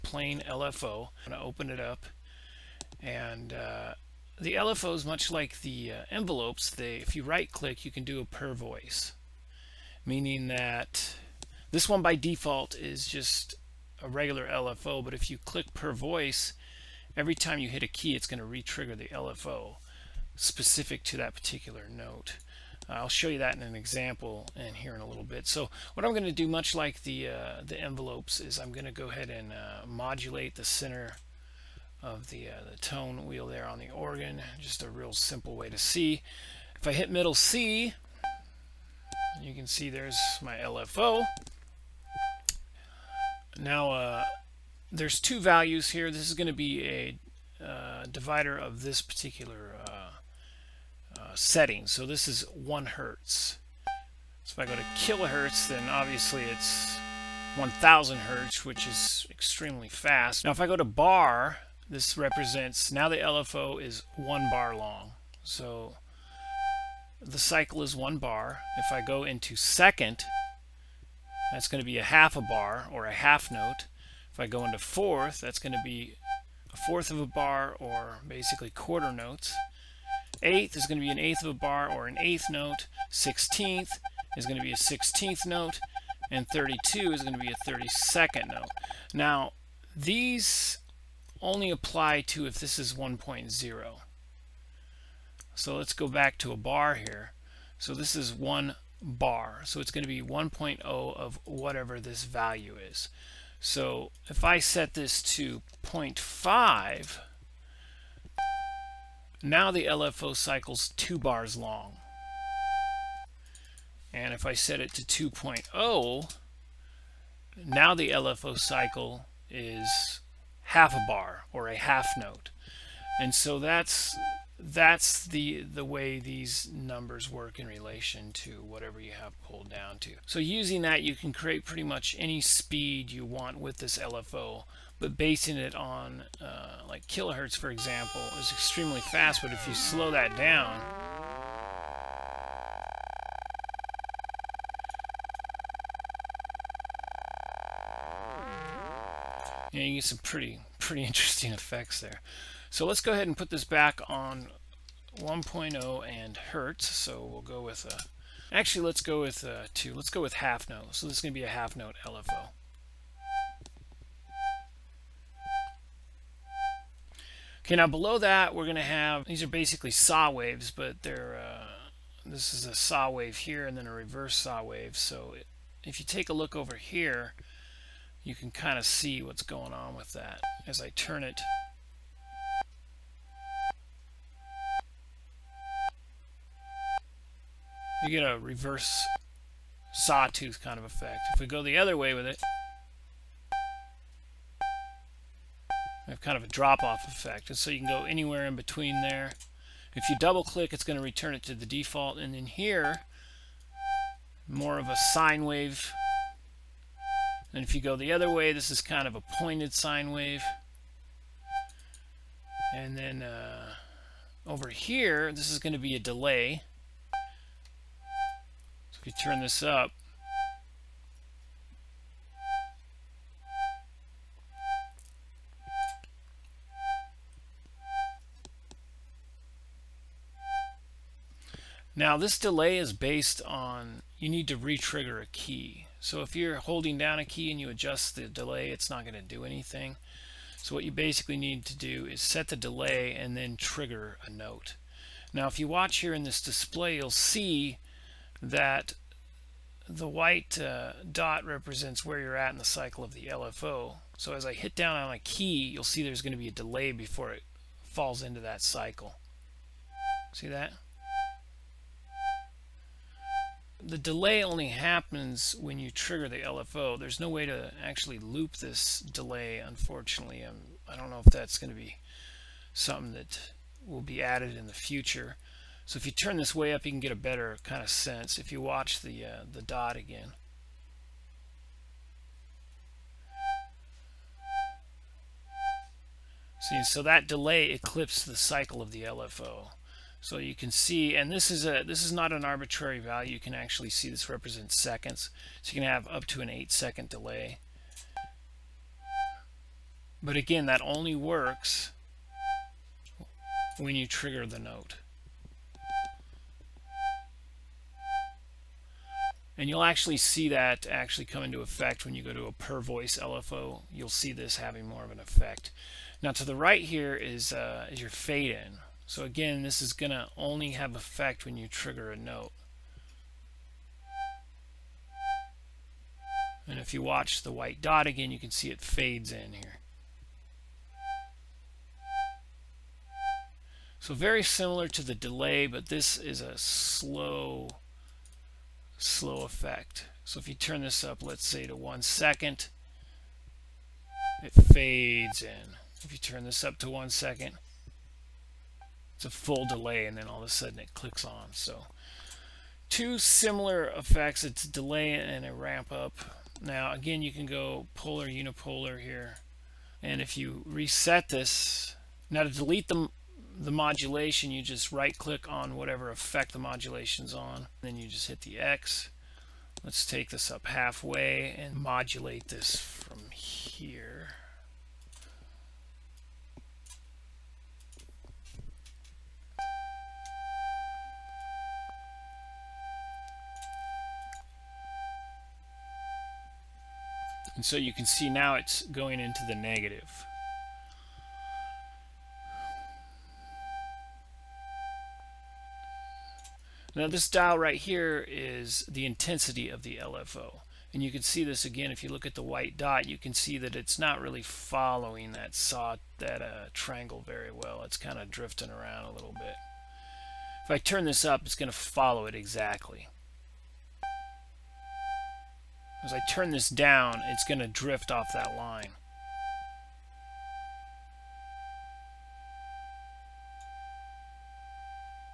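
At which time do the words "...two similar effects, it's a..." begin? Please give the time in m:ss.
5:52.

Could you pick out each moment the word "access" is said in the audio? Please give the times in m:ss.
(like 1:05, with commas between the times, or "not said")
not said.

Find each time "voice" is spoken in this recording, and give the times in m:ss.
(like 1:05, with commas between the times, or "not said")
0:08, 0:15, 5:12.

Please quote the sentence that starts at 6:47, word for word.
It's kind of drifting around a little bit.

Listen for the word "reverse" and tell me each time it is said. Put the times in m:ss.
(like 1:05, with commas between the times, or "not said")
2:53, 3:08.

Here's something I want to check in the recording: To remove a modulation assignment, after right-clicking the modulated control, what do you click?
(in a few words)
the X.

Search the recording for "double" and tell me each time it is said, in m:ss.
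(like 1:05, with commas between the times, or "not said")
3:20.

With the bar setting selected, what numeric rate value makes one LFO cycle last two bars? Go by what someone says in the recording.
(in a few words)
0.5.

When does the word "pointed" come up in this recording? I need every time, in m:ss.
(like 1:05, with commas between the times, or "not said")
3:29.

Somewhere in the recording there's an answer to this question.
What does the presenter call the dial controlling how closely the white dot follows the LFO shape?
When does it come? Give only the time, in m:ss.
6:39.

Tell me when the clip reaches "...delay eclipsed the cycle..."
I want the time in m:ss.
4:47.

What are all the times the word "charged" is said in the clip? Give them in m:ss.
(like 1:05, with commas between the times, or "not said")
not said.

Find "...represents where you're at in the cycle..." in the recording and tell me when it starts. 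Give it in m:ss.
4:11.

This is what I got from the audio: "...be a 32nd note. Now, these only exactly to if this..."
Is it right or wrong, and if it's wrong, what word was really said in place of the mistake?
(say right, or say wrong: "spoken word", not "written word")
wrong: "apply", not "exactly".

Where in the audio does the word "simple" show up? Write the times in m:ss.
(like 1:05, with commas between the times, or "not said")
0:35.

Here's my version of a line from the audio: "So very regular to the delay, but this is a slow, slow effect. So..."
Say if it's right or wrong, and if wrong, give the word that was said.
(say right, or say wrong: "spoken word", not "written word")
wrong: "similar", not "regular".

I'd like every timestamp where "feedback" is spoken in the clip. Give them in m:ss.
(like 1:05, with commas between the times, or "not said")
not said.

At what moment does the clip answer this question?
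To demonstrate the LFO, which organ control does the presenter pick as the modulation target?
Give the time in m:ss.
0:32.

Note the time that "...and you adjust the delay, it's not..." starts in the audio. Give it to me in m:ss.
3:57.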